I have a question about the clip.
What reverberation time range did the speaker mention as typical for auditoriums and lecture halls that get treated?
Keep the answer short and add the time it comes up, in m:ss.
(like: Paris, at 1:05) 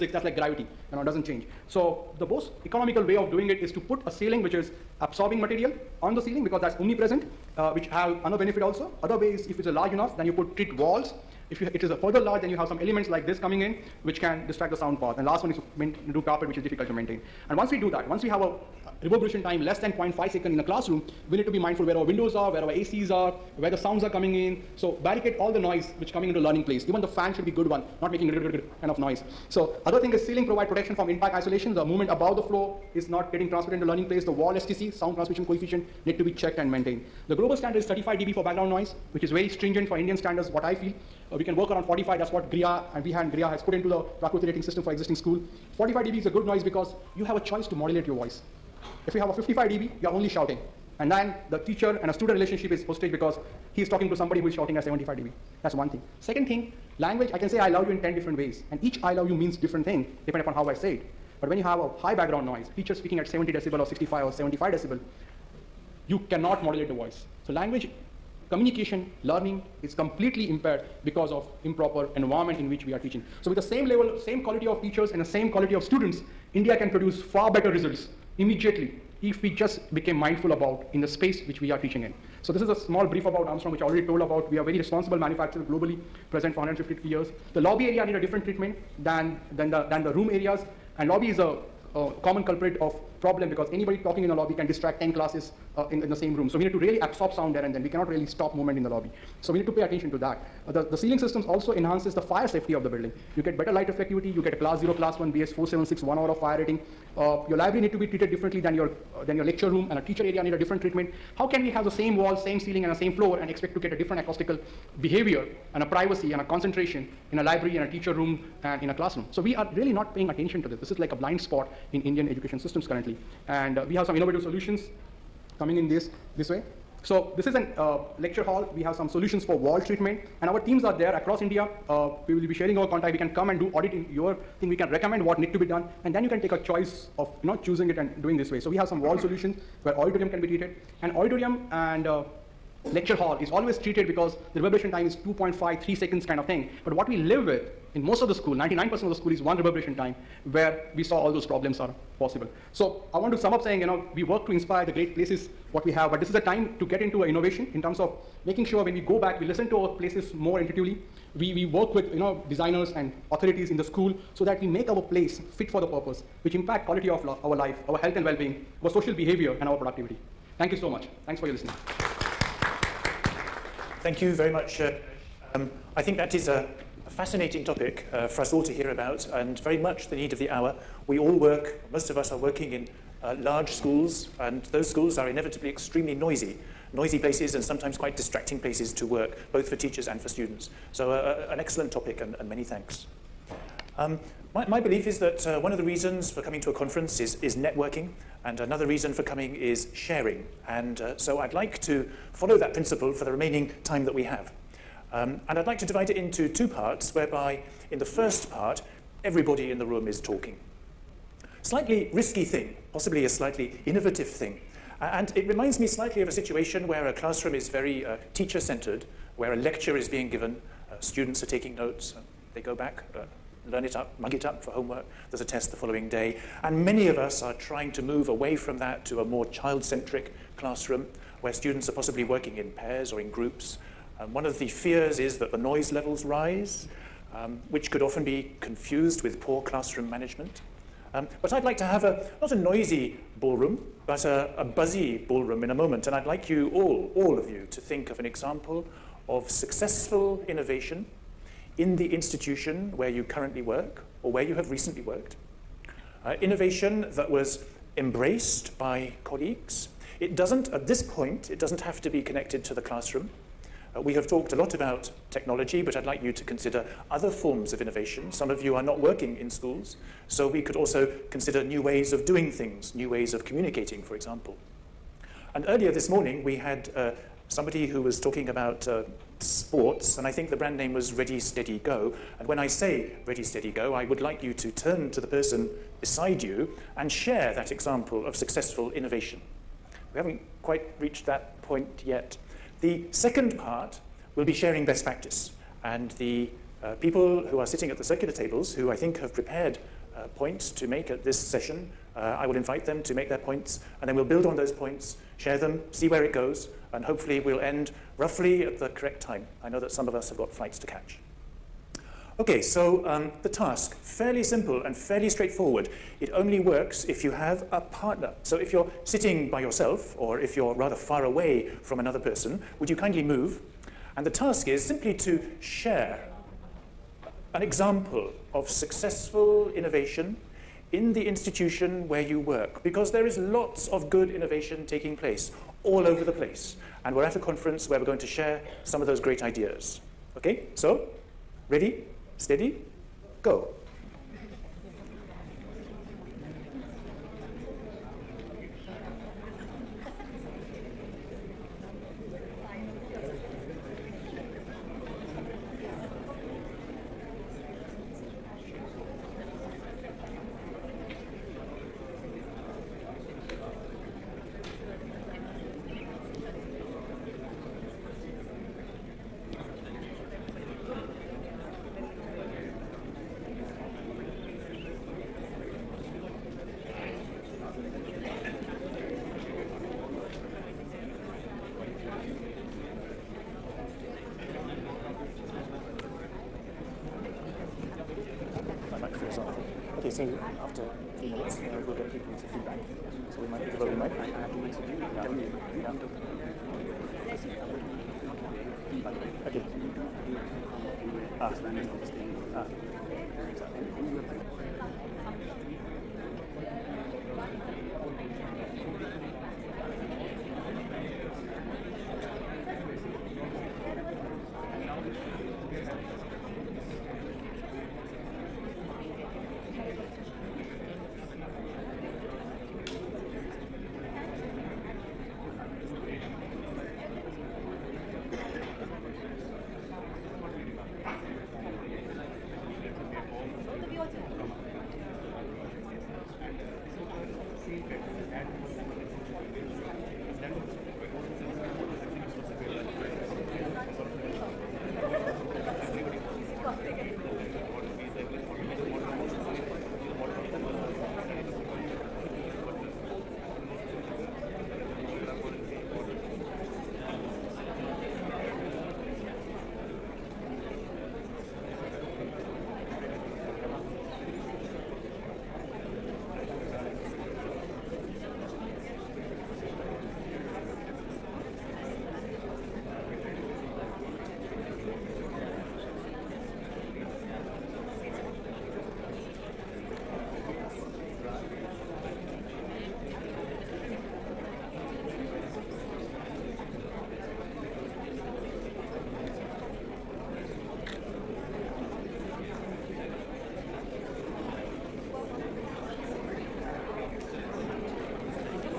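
2.5 to 3 seconds, at 2:25.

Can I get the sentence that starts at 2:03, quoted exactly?
And uh, we have some innovative solutions coming in this, this way.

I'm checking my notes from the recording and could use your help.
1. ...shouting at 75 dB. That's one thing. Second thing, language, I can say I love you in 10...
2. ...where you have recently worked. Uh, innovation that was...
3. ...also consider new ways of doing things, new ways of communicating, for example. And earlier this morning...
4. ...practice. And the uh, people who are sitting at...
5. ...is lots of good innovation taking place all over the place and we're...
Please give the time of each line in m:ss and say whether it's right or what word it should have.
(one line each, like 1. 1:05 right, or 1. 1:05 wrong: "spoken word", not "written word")
1. 0:54 right
2. 4:14 right
3. 4:30 right
4. 4:55 right
5. 5:33 right.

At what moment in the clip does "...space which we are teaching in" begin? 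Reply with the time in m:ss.
1:21.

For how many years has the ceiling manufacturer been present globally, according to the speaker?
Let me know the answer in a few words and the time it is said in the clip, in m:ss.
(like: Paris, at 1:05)
150 years, at 1:26.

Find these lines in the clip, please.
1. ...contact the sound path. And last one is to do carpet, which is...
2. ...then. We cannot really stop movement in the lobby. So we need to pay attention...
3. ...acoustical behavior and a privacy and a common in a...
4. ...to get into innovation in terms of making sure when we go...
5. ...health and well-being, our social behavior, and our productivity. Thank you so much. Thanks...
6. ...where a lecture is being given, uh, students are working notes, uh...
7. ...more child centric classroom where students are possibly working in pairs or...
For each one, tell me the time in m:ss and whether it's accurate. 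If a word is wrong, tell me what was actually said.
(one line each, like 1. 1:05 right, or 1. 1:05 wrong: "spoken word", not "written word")
1. 0:14 wrong: "distract", not "contact"
2. 1:37 right
3. 1:54 wrong: "concentration", not "common"
4. 2:36 right
5. 2:47 right
6. 3:39 wrong: "taking", not "working"
7. 3:49 right.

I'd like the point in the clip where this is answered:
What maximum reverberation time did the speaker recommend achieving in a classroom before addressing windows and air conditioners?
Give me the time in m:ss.
0:19.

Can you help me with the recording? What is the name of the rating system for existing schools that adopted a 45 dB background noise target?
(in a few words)
Prakruti.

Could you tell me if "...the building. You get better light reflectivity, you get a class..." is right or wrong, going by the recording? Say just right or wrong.
right.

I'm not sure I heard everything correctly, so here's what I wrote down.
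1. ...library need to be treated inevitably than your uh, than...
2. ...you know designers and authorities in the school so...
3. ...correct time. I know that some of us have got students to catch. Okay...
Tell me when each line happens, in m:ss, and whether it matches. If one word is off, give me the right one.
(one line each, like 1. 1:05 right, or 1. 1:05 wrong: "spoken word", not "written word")
1. 1:47 wrong: "differently", not "inevitably"
2. 2:42 right
3. 5:08 wrong: "flights", not "students".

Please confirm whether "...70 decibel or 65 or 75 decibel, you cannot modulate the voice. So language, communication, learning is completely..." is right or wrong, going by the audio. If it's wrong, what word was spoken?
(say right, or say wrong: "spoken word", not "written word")
right.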